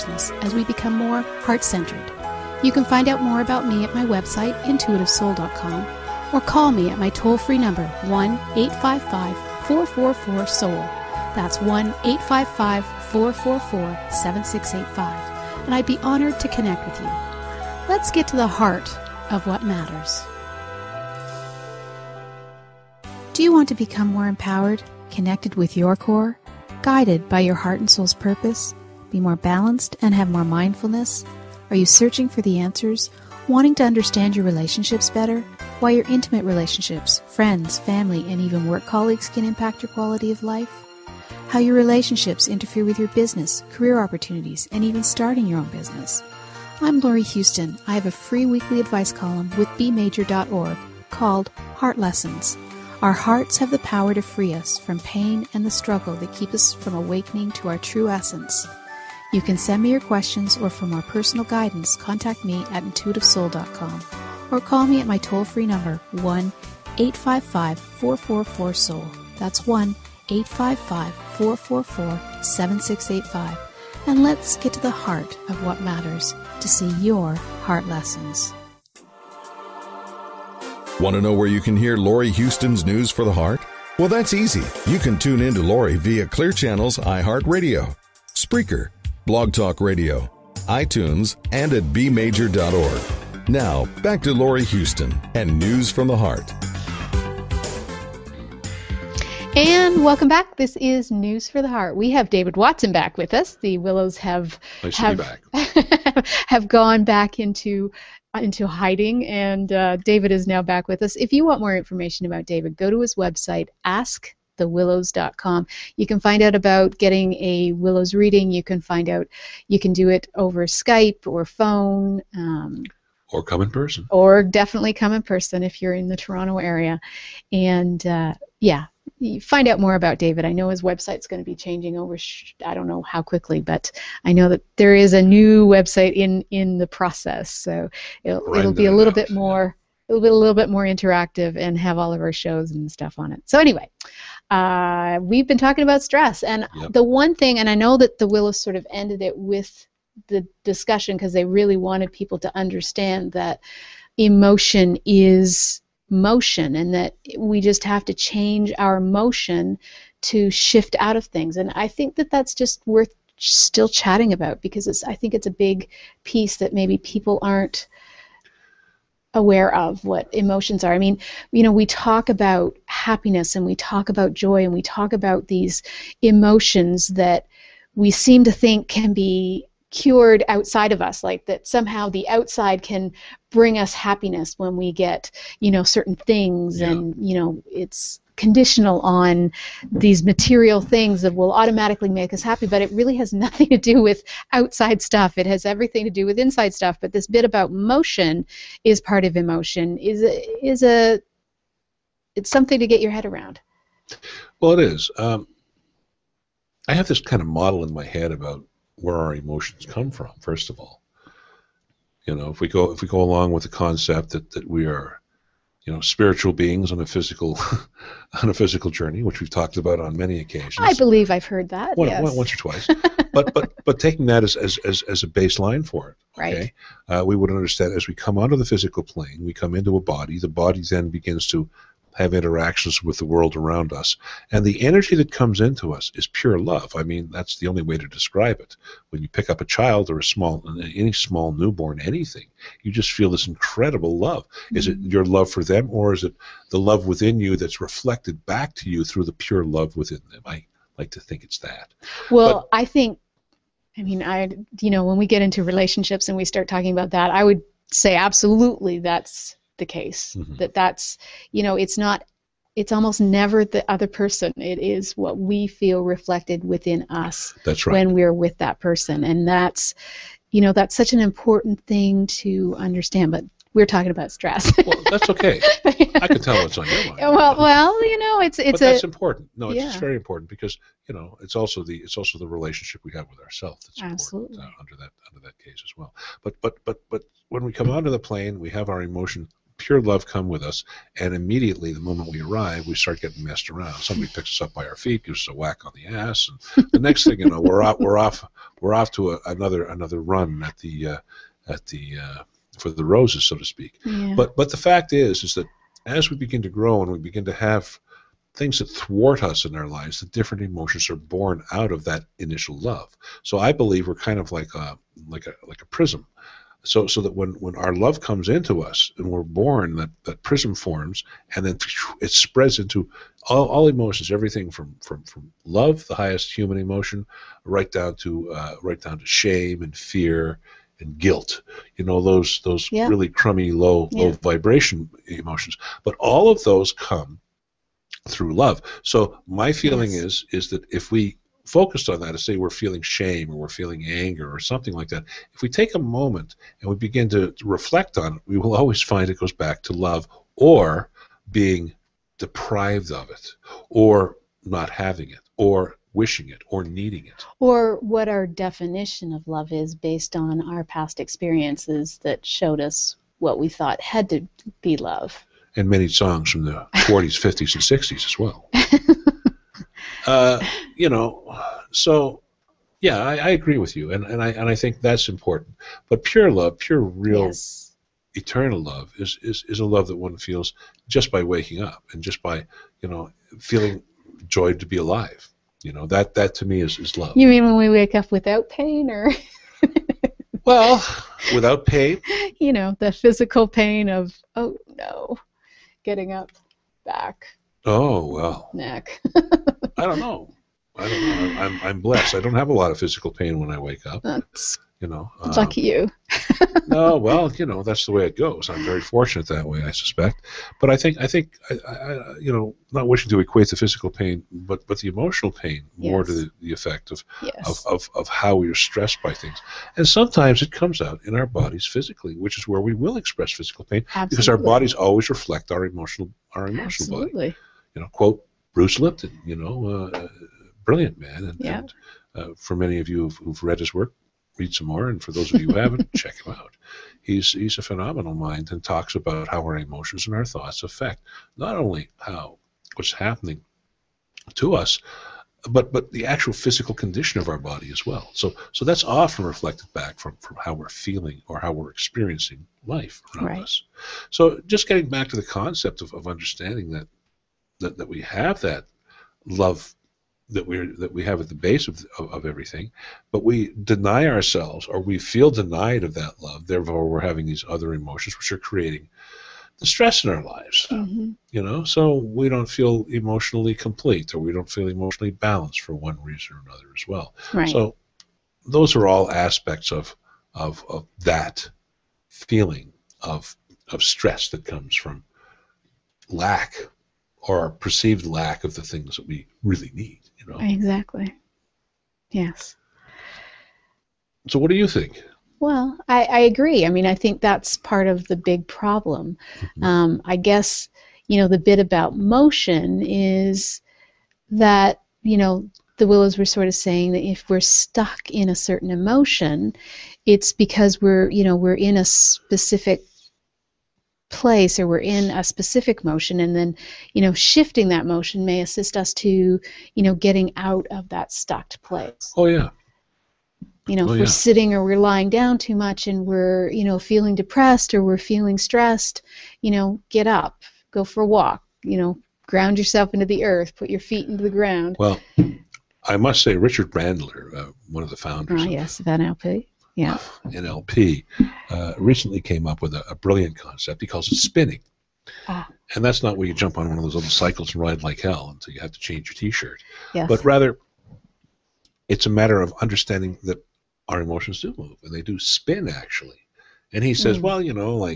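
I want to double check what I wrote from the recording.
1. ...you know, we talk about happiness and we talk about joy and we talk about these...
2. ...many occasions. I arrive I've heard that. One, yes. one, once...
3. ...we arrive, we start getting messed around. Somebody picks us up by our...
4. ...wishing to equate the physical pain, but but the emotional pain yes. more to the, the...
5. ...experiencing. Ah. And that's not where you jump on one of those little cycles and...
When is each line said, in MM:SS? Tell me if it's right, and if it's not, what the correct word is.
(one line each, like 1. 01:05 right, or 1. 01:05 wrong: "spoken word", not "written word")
1. 02:51 right
2. 03:40 wrong: "believe", not "arrive"
3. 04:52 right
4. 06:53 right
5. 09:04 wrong: "spinning", not "experiencing".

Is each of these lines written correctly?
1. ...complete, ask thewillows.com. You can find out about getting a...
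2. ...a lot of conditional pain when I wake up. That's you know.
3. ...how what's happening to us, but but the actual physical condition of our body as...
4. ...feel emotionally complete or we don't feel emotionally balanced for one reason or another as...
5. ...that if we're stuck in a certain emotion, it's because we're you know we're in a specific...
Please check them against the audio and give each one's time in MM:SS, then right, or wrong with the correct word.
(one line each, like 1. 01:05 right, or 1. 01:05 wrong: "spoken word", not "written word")
1. 01:53 wrong: "website", not "complete"
2. 06:42 wrong: "physical", not "conditional"
3. 07:22 right
4. 07:52 right
5. 08:27 right.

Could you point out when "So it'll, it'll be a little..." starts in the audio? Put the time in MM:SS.
02:17.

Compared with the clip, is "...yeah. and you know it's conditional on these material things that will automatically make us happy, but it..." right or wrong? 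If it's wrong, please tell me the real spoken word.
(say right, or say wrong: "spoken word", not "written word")
right.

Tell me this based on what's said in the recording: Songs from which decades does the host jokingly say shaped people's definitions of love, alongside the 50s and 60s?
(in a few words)
the 40s.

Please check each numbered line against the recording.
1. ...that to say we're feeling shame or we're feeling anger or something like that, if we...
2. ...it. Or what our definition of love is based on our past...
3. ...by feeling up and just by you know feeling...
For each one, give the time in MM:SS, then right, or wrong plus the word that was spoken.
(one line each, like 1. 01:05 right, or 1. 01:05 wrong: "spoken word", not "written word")
1. 05:42 right
2. 05:57 right
3. 06:21 wrong: "waking", not "feeling".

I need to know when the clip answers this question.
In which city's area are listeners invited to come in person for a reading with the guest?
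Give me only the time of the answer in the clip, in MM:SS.
02:06.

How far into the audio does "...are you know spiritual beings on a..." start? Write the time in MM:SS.
03:34.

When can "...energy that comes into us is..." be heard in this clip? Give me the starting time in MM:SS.
03:54.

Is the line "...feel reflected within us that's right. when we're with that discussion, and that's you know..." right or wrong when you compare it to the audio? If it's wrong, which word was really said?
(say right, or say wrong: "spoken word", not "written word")
wrong: "person", not "discussion".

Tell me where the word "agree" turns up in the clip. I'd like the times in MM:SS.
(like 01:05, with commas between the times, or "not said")
06:13, 08:16.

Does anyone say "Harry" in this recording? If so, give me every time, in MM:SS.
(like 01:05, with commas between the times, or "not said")
not said.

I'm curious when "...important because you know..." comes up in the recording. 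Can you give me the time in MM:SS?
04:40.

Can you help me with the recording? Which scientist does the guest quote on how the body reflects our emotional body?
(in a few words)
Bruce Lipton.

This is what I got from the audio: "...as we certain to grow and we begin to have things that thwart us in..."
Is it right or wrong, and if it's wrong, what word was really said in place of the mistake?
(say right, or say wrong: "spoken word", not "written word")
wrong: "begin", not "certain".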